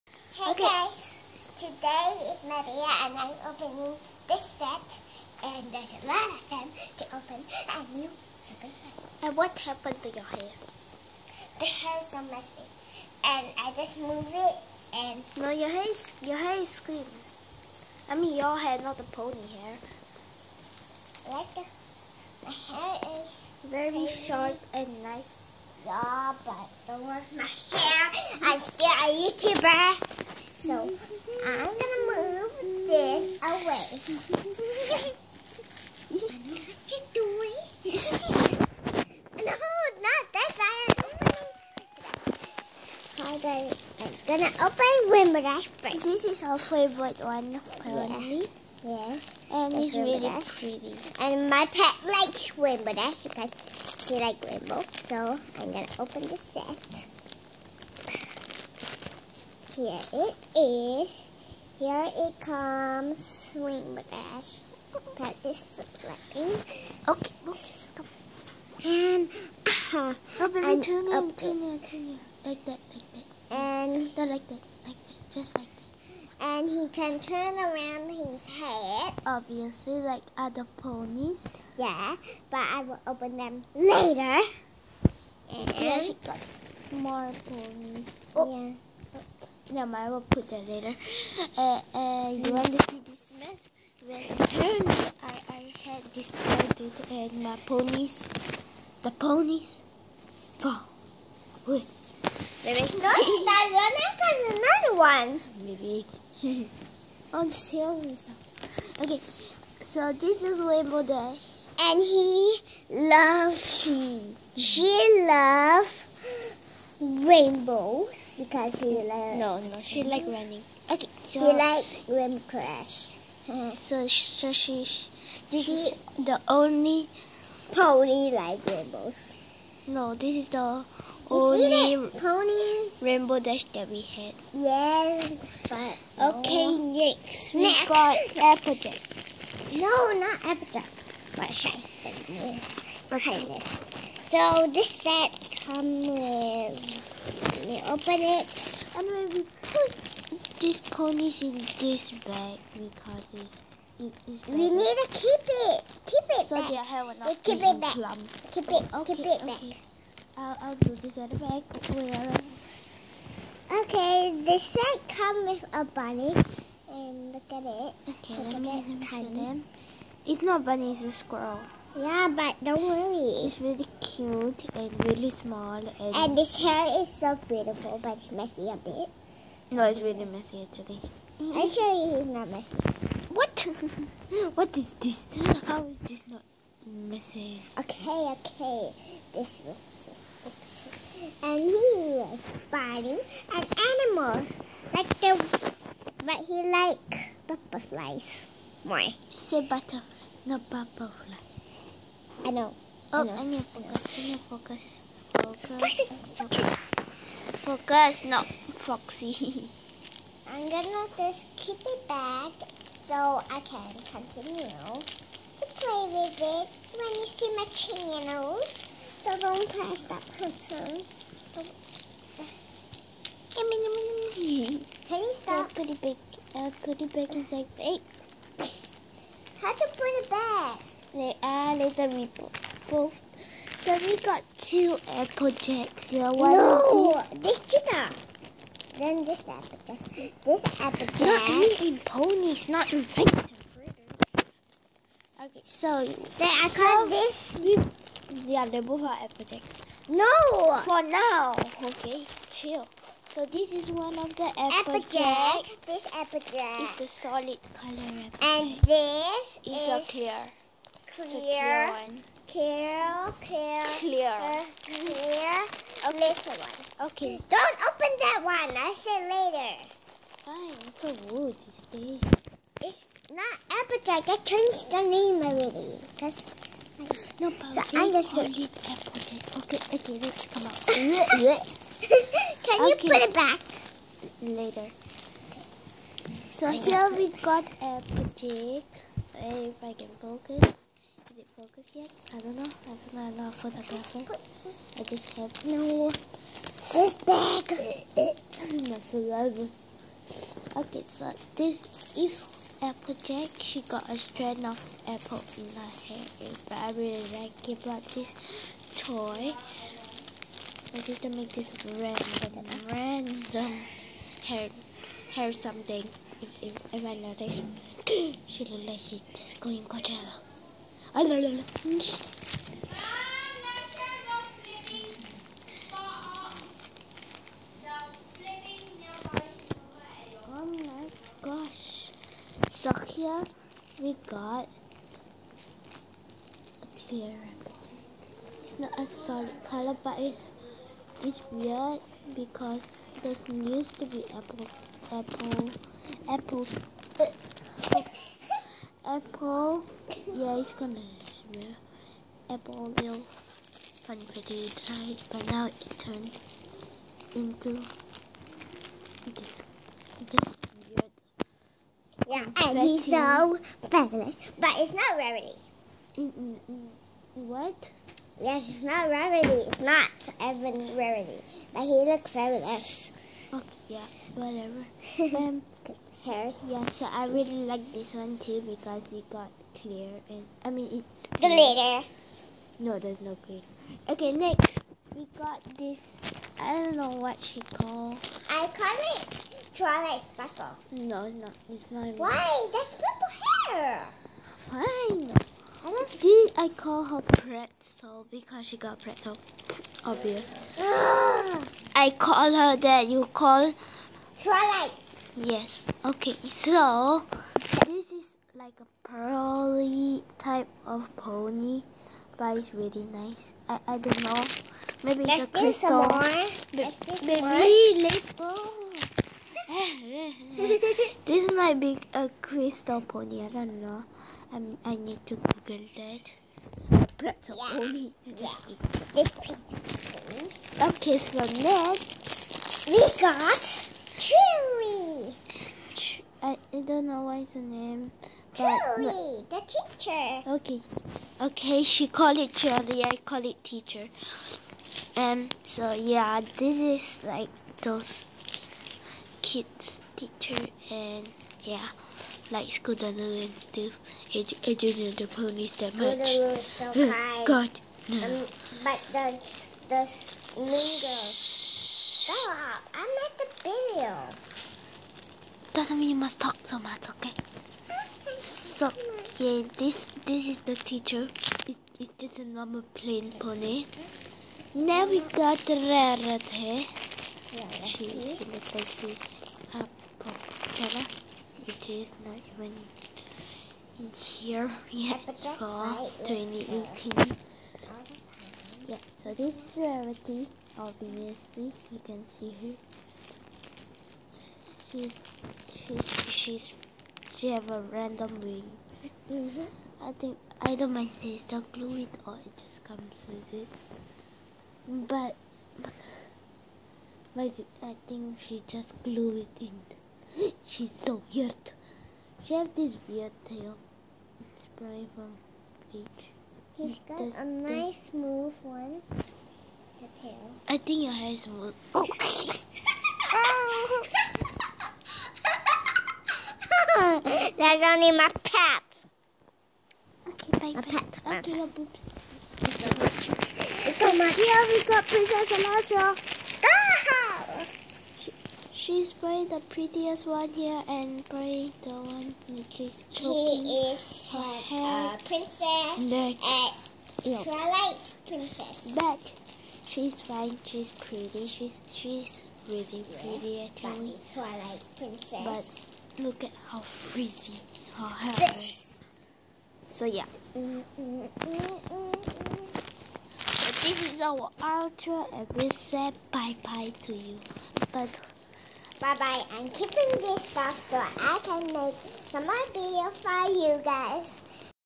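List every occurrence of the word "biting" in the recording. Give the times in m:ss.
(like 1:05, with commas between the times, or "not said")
3:12.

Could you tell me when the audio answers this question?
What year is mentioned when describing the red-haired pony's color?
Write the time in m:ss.
8:06.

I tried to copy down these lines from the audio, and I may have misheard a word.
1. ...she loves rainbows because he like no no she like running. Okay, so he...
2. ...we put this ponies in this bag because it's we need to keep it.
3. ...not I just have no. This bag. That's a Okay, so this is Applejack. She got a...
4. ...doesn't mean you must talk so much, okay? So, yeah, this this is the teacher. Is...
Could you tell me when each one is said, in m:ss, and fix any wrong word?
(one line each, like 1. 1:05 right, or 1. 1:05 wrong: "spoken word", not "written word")
1. 1:54 right
2. 2:29 right
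3. 4:53 right
4. 7:45 right.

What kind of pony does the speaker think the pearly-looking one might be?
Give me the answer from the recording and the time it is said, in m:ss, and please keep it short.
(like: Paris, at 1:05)
crystal pony, at 7:02.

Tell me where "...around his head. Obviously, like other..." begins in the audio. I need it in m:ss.
1:17.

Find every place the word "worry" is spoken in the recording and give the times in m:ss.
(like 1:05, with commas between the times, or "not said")
0:27, 2:52.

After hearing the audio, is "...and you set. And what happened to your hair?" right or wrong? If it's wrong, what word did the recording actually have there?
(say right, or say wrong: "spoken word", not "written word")
right.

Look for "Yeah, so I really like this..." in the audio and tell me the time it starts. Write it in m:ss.
6:16.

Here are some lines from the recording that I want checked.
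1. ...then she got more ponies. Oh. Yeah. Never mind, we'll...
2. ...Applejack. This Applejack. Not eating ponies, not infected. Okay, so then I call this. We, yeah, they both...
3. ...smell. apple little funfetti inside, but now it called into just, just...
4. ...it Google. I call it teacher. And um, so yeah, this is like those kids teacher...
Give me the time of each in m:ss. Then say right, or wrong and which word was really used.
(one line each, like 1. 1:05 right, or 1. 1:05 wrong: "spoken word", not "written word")
1. 1:25 right
2. 3:59 right
3. 5:50 wrong: "turned", not "called"
4. 7:22 wrong: "Truly", not "Google".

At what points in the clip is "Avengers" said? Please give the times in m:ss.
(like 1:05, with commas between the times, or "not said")
not said.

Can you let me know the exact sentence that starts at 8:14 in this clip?
She, choose she have a random wing.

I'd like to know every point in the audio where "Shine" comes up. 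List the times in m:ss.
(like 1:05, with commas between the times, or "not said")
2:21.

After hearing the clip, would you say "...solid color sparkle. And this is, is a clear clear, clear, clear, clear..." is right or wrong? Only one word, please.
wrong.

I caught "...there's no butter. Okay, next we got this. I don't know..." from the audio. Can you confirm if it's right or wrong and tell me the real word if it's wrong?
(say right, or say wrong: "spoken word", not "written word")
wrong: "glitter", not "butter".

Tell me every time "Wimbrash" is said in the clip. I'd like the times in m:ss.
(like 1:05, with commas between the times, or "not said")
0:45, 0:52.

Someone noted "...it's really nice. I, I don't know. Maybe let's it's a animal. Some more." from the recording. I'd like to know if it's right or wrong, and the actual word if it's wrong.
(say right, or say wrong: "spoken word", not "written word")
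wrong: "crystal", not "animal".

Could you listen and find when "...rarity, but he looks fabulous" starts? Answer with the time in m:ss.
6:10.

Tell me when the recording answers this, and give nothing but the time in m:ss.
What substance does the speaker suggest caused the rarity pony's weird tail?
8:35.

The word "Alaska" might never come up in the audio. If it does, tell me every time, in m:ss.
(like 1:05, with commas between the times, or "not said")
8:55.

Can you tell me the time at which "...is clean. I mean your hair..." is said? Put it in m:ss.
0:16.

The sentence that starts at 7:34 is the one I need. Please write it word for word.
It I didn't the ponies that much.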